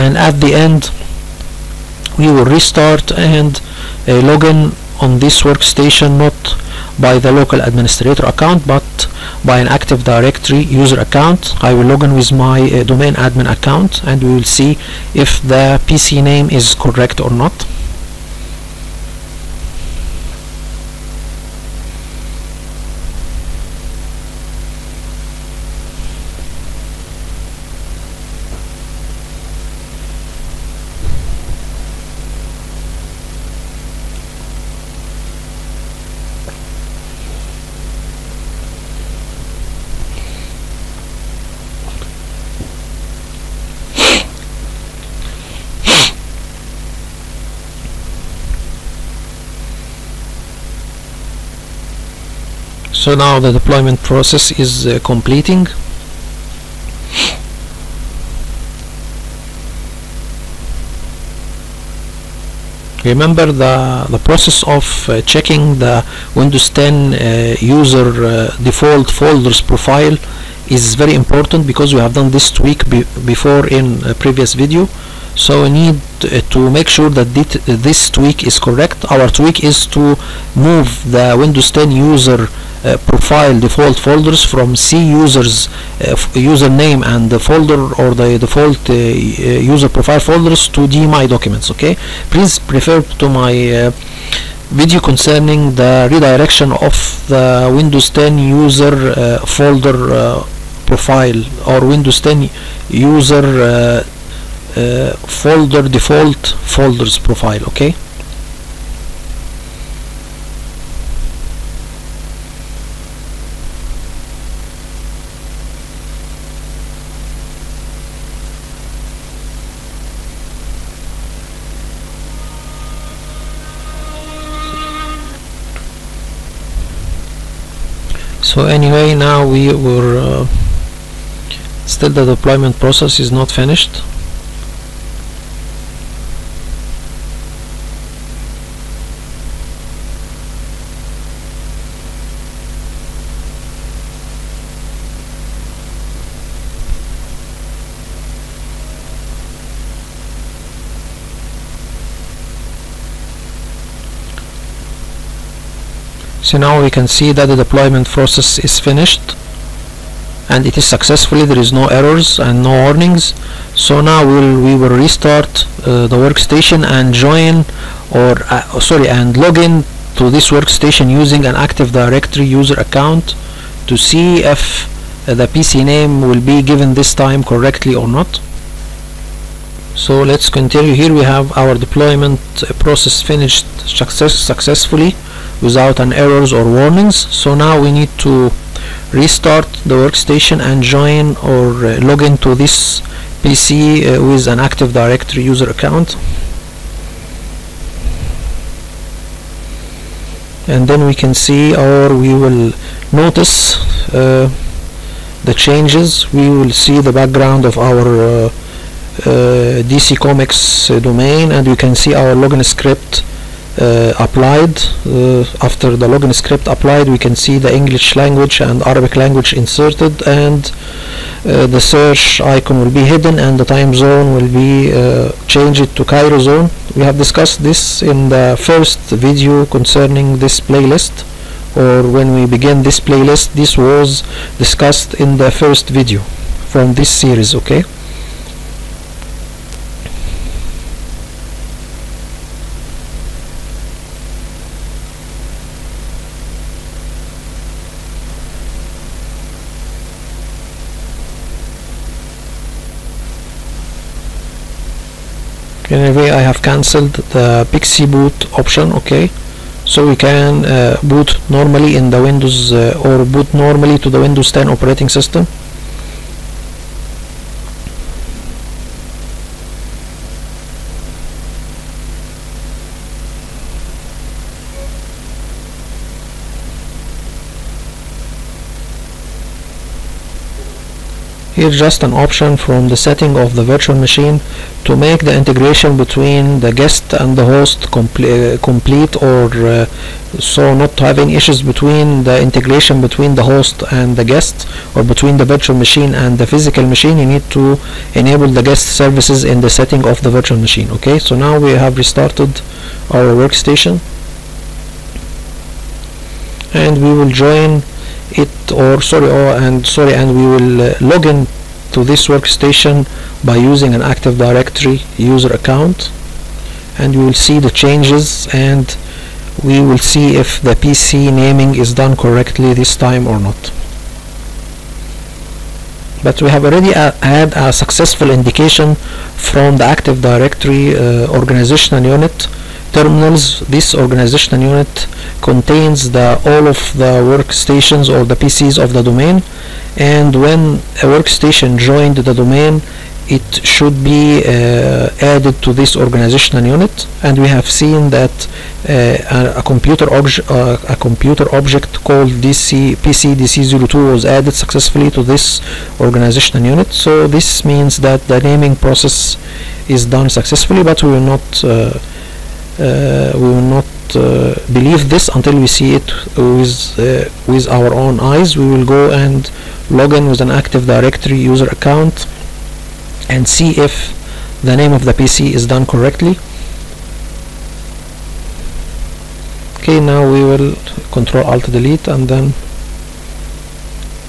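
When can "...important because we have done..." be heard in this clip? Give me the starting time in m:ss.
1:11.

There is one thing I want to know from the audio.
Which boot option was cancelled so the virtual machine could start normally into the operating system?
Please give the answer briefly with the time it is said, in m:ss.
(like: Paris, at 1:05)
PXE boot, at 4:17.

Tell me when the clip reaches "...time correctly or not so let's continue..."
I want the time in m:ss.
2:57.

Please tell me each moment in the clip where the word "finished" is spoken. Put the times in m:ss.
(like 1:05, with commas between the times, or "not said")
2:13, 2:38, 3:03.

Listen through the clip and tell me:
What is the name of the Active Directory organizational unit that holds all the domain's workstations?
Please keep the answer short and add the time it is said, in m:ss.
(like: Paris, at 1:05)
terminals, at 5:32.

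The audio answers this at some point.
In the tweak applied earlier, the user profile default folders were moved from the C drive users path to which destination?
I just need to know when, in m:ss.
1:30.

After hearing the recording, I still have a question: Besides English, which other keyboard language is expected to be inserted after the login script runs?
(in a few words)
Arabic.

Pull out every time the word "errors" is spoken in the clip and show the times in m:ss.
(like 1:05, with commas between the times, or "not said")
2:41, 3:06.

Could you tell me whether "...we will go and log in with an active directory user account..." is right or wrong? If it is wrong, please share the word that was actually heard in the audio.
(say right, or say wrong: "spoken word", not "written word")
right.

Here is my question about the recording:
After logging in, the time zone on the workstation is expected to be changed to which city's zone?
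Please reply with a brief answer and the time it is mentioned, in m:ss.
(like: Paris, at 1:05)
Cairo, at 3:46.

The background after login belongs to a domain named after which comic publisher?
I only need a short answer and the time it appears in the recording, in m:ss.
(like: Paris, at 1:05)
DC Comics, at 3:29.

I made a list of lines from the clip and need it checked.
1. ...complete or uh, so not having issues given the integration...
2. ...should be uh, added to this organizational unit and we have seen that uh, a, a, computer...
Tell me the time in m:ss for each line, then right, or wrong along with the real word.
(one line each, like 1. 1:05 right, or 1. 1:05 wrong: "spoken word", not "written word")
1. 4:48 wrong: "between", not "given"
2. 5:43 right.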